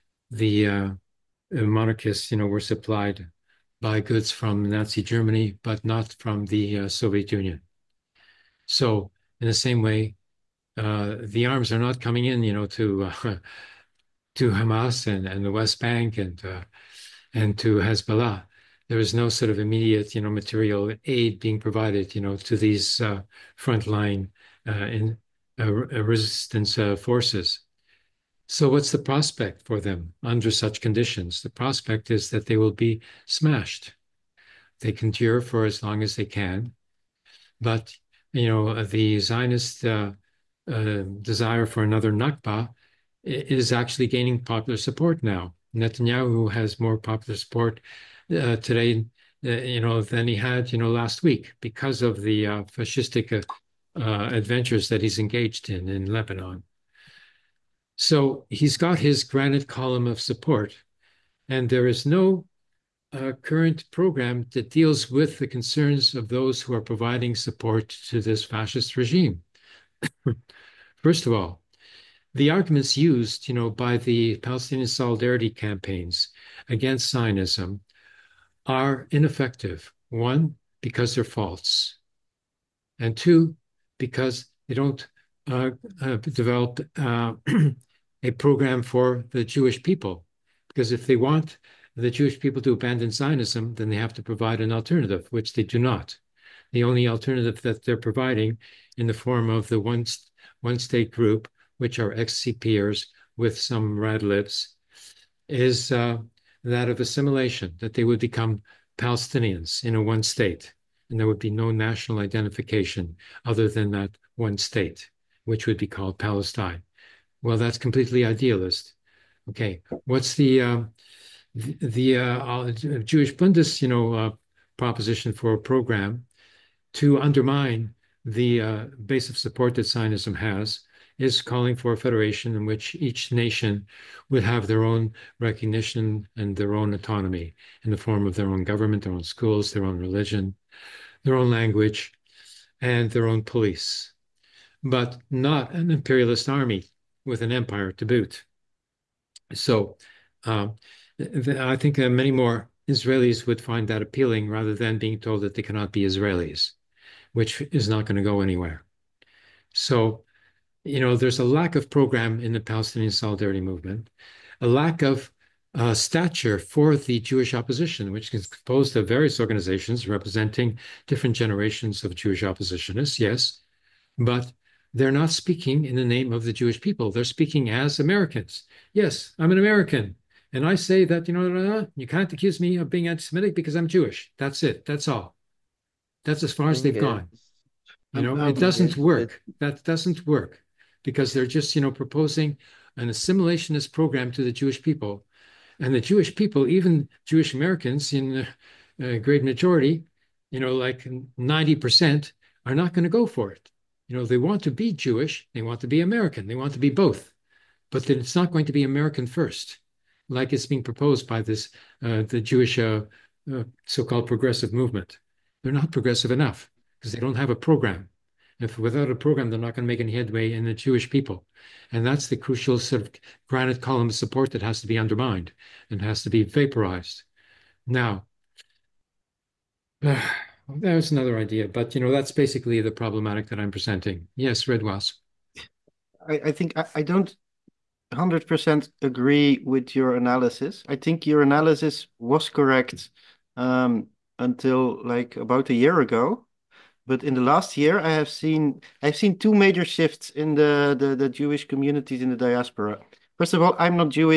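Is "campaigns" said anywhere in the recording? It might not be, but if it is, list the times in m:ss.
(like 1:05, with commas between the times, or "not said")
1:15.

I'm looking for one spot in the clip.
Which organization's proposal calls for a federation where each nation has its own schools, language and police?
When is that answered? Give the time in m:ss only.
2:02.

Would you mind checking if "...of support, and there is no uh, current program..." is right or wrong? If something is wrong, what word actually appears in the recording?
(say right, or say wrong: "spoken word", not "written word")
right.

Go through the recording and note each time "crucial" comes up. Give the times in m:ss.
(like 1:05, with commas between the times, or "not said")
3:42.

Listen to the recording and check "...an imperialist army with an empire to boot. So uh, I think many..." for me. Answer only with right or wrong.
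right.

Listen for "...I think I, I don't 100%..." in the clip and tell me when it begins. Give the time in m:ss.
3:56.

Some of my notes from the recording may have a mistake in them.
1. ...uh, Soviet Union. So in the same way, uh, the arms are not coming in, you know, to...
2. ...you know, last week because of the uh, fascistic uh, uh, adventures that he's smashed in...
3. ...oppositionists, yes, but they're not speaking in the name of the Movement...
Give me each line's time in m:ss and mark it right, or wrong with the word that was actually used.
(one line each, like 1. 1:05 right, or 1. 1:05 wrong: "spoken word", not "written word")
1. 0:06 right
2. 0:50 wrong: "engaged", not "smashed"
3. 2:52 wrong: "Jewish", not "Movement".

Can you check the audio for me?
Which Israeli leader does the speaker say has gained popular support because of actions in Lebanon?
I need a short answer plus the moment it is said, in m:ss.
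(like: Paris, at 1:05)
Netanyahu, at 0:45.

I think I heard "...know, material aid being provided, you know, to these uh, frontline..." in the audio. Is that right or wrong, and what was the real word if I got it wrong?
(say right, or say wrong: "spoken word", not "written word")
right.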